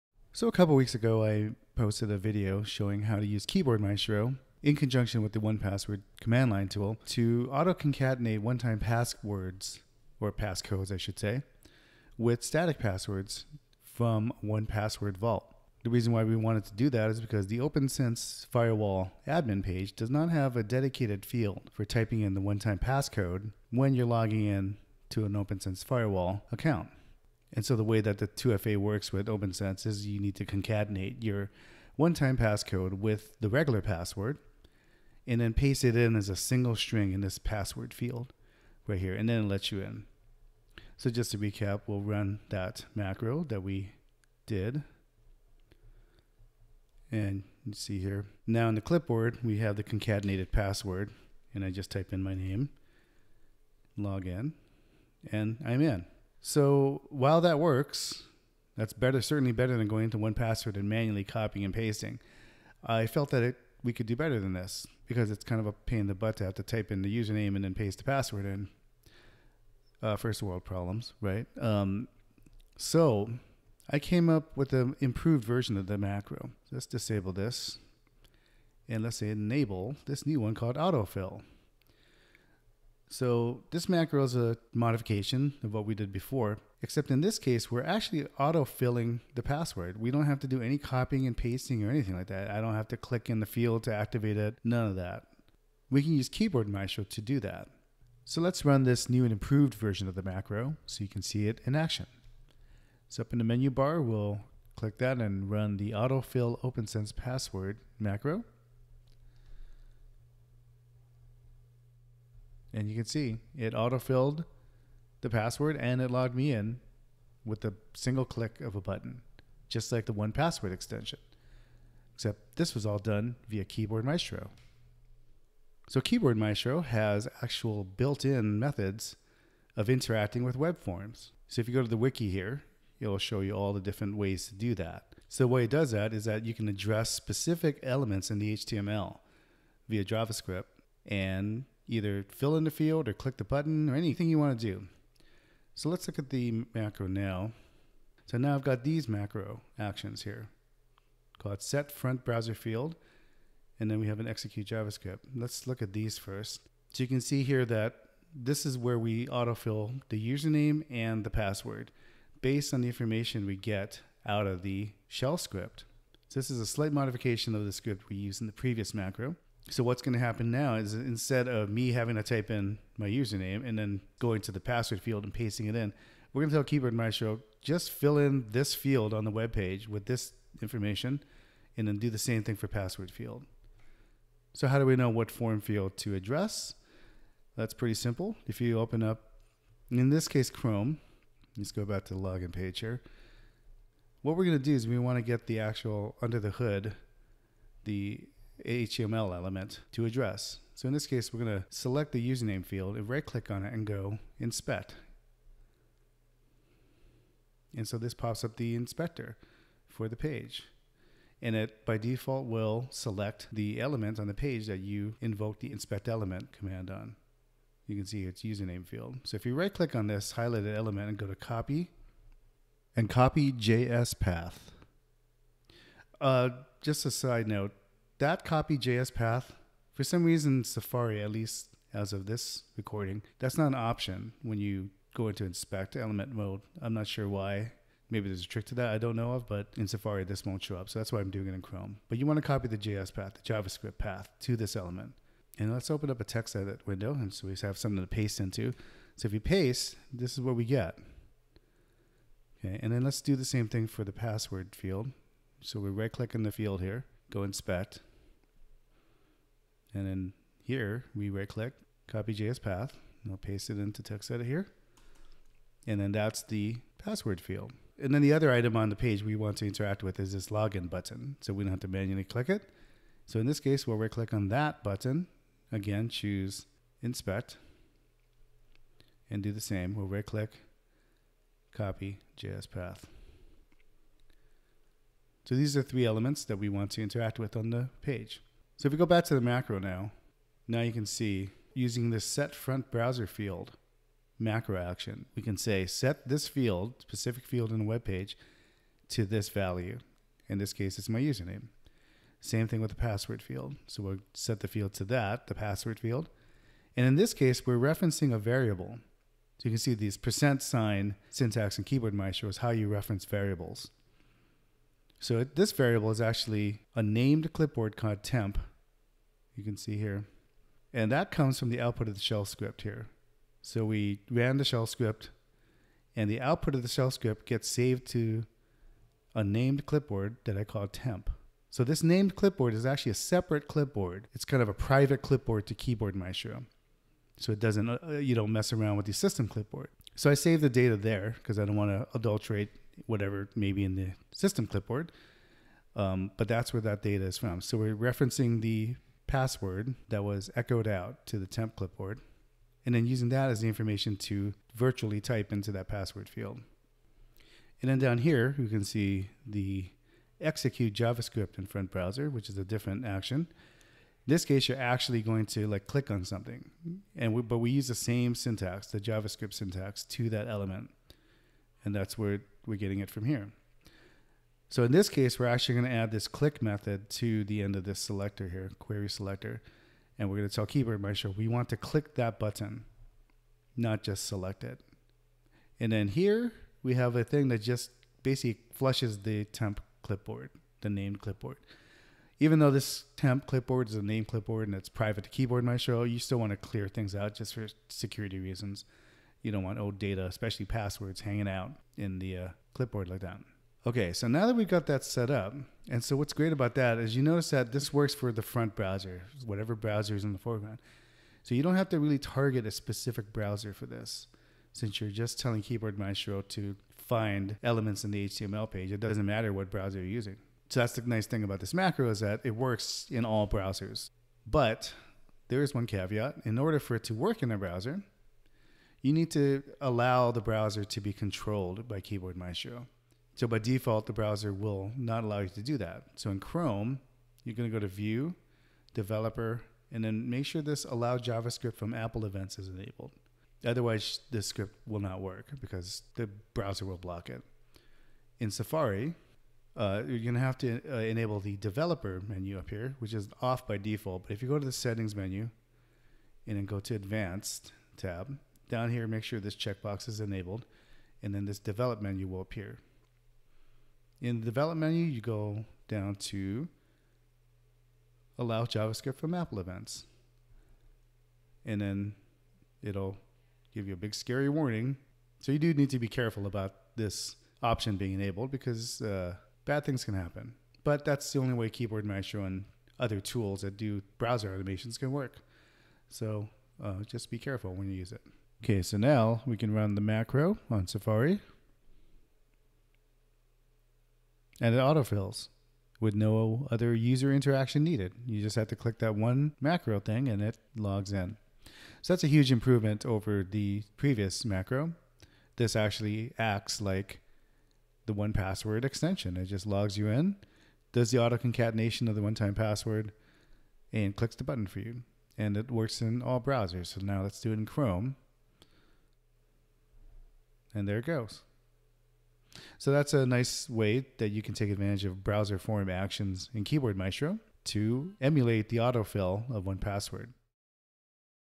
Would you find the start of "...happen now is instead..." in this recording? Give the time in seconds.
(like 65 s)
170 s.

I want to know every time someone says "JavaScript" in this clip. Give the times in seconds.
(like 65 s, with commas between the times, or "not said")
140 s, 154 s, 243 s, 360 s, 368 s, 441 s, 468 s.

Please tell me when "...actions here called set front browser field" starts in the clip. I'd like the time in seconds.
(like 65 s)
149 s.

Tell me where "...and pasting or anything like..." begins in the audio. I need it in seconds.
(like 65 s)
91 s.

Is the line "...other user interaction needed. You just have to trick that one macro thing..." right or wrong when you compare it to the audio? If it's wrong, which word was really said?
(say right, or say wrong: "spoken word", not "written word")
wrong: "click", not "trick".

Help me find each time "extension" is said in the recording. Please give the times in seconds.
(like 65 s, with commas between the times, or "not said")
120 s, 508 s.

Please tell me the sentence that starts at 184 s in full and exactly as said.
So how do we know what form field to address?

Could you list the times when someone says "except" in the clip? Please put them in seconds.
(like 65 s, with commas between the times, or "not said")
86 s, 122 s.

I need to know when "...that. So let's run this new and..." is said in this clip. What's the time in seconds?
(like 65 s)
97 s.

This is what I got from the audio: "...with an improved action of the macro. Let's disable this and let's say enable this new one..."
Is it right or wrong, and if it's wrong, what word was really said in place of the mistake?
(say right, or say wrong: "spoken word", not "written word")
wrong: "version", not "action".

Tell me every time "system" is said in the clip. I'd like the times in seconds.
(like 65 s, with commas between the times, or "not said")
339 s, 344 s.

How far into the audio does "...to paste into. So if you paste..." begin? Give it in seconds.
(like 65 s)
247 s.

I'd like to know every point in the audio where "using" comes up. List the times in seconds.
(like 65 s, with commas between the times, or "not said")
291 s, 353 s, 420 s.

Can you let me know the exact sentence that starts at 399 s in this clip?
You don't want old data, especially passwords, hanging out in the uh, clipboard like that.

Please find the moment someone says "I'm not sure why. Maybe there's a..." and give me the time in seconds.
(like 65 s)
236 s.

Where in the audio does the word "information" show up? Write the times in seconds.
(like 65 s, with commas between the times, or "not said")
162 s, 180 s, 353 s.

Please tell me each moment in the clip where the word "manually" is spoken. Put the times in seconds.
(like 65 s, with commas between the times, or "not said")
60 s, 271 s.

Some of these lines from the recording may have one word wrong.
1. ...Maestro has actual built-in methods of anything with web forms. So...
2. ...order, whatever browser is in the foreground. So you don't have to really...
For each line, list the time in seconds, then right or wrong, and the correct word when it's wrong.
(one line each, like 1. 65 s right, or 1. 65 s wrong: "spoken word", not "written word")
1. 126 s wrong: "interacting", not "anything"
2. 408 s wrong: "browser", not "order".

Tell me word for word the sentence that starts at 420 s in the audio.
So that's the nice thing about this macro is that it works in all browsers.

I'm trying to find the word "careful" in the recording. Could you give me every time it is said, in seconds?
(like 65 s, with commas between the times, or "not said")
476 s, 487 s.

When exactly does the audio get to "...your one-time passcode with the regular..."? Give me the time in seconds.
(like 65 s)
31 s.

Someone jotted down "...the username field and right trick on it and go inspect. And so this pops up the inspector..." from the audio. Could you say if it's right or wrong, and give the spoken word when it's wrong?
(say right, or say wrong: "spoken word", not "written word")
wrong: "click", not "trick".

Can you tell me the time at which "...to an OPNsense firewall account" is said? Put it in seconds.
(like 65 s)
25 s.